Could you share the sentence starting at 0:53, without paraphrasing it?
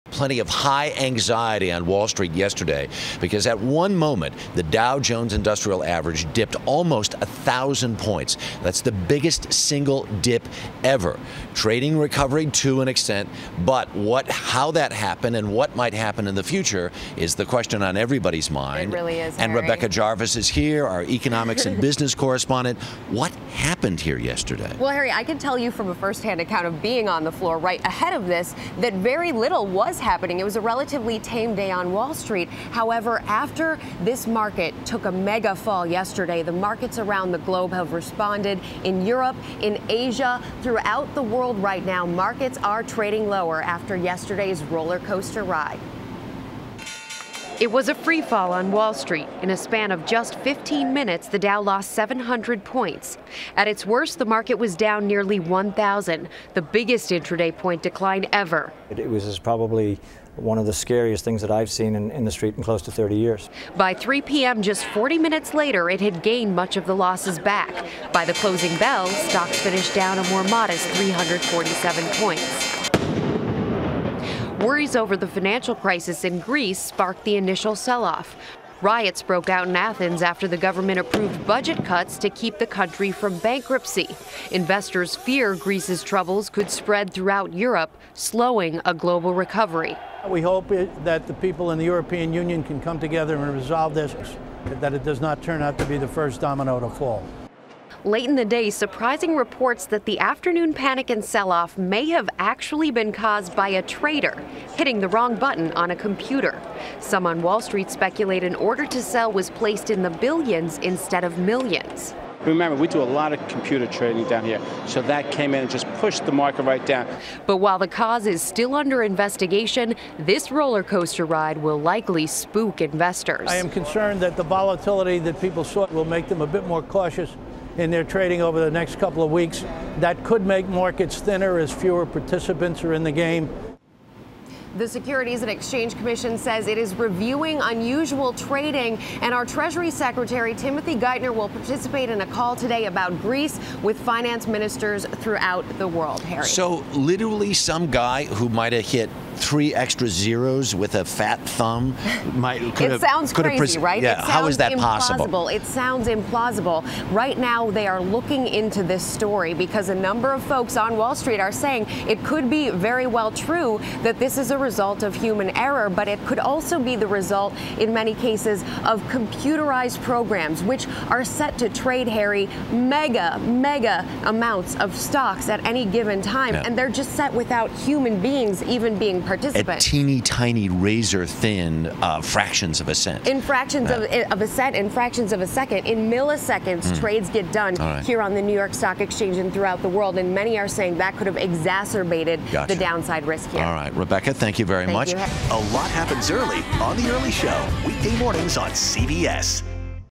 At its worst, the market was down nearly 1,000, the biggest intraday point decline ever.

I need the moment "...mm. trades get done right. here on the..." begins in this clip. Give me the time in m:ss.
3:06.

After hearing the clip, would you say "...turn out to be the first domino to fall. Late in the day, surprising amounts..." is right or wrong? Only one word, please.
wrong.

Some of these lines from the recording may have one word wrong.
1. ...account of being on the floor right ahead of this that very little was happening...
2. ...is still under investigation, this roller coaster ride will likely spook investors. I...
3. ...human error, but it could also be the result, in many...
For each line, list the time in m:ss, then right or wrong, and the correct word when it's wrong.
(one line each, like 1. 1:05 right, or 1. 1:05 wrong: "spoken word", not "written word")
1. 0:26 right
2. 1:58 right
3. 2:45 right.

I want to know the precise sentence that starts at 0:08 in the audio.
That's the biggest single dip ever.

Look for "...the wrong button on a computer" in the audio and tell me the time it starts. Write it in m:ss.
1:44.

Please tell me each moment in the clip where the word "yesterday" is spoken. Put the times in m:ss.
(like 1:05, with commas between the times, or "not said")
0:02, 0:24, 0:35, 0:43.